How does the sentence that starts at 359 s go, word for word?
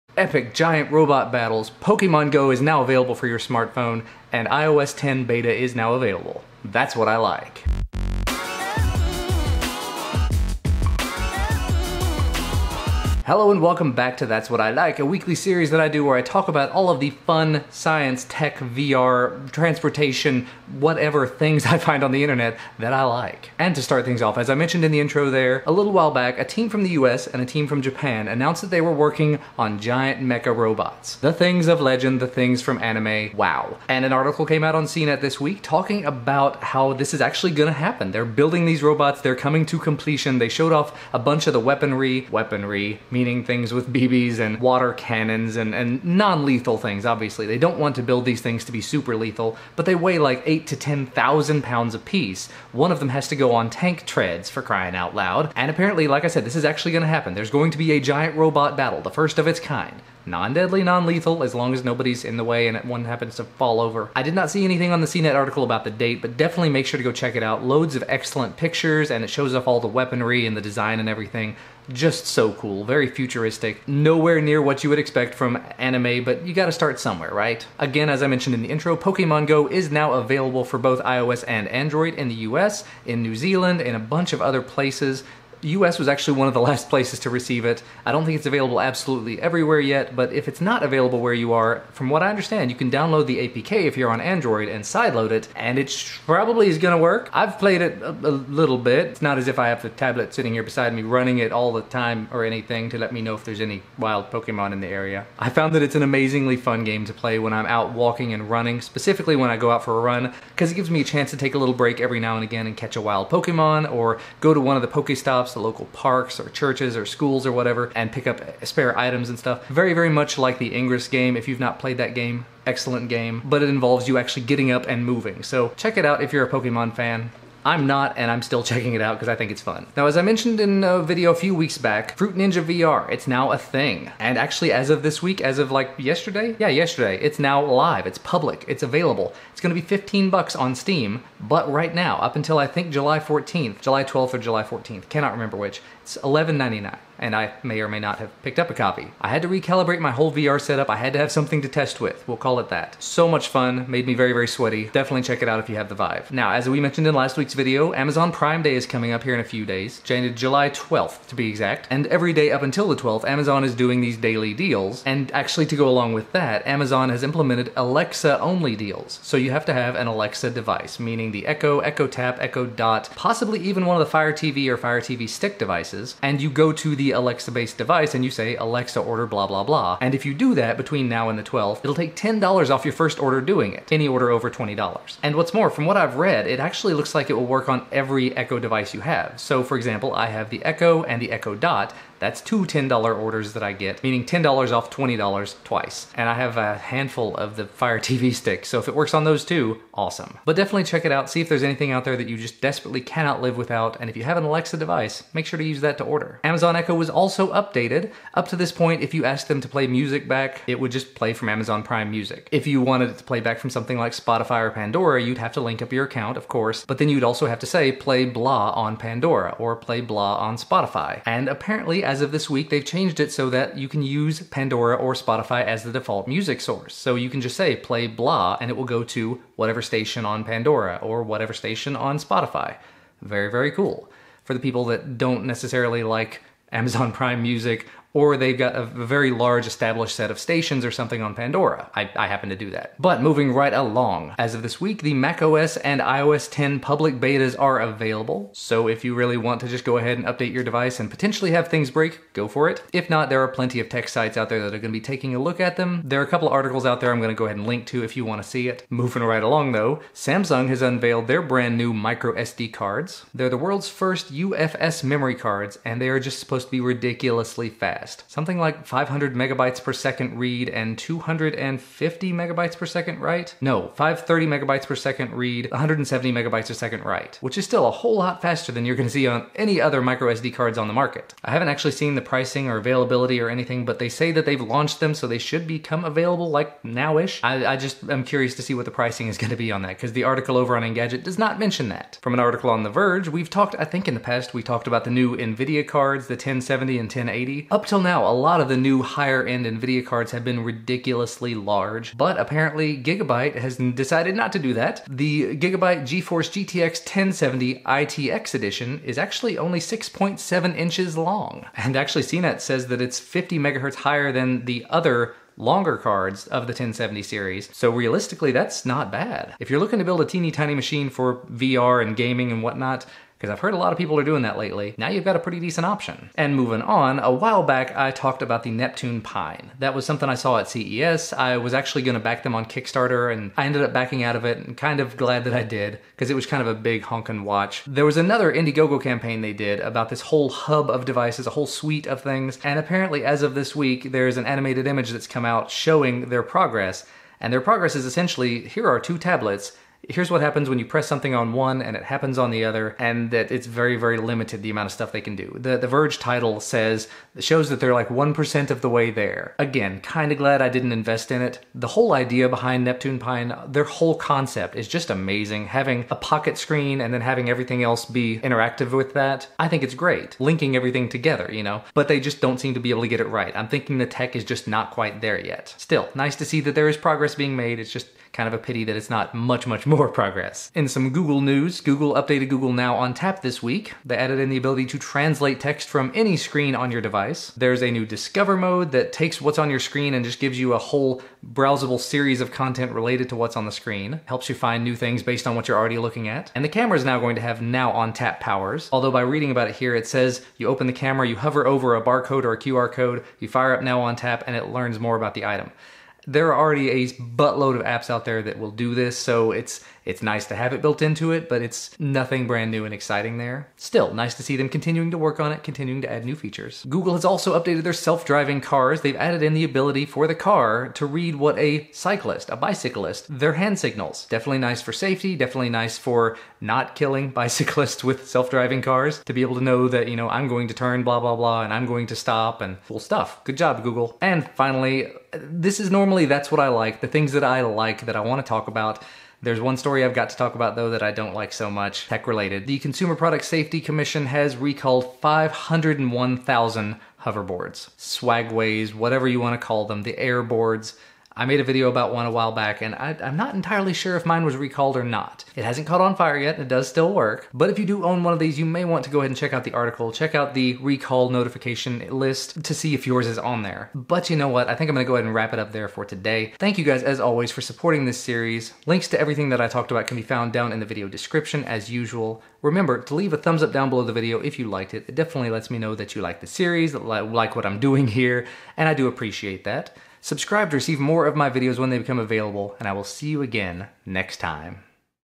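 Again, kind of glad I didn't invest in it.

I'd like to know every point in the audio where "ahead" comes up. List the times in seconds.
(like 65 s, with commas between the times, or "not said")
249 s, 257 s, 459 s, 465 s.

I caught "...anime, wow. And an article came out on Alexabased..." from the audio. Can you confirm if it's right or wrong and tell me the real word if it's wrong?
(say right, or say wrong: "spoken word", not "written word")
wrong: "CNET", not "Alexabased".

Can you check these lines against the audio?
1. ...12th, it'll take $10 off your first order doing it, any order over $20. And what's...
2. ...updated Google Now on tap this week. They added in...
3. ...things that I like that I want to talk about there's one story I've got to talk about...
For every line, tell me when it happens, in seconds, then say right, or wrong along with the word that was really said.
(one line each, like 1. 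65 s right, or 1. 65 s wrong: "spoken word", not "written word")
1. 181 s right
2. 382 s right
3. 437 s right.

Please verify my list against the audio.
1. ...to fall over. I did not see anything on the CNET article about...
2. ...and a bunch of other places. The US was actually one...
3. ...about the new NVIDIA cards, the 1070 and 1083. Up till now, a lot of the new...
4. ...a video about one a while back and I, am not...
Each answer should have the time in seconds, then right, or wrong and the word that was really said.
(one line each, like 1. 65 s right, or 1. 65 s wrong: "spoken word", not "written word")
1. 63 s right
2. 83 s right
3. 294 s wrong: "1080", not "1083"
4. 451 s right.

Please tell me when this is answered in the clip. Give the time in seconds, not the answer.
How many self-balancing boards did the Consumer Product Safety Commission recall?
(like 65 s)
445 s.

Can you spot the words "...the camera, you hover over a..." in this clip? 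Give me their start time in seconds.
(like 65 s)
400 s.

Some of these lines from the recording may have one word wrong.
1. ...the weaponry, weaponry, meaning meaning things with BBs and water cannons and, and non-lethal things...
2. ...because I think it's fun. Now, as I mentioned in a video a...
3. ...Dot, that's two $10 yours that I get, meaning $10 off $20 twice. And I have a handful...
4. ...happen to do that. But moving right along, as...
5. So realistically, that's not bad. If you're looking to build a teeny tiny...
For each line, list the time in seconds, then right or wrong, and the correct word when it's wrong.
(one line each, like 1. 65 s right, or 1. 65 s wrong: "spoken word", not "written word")
1. 41 s right
2. 129 s right
3. 191 s wrong: "orders", not "yours"
4. 242 s right
5. 317 s right.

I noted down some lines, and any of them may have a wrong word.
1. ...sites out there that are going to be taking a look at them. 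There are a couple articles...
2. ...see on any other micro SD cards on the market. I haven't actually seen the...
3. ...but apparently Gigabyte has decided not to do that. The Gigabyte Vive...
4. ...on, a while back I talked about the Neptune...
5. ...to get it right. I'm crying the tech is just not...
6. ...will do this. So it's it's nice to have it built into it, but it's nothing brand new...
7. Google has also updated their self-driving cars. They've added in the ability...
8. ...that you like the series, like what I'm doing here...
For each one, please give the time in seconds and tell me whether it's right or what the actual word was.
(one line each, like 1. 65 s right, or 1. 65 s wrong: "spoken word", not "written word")
1. 254 s right
2. 279 s right
3. 302 s wrong: "GeForce", not "Vive"
4. 326 s right
5. 373 s wrong: "thinking", not "crying"
6. 408 s right
7. 416 s right
8. 475 s right.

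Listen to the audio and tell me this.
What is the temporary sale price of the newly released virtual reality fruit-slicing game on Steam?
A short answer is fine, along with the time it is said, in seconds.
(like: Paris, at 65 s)
$11.99, at 146 s.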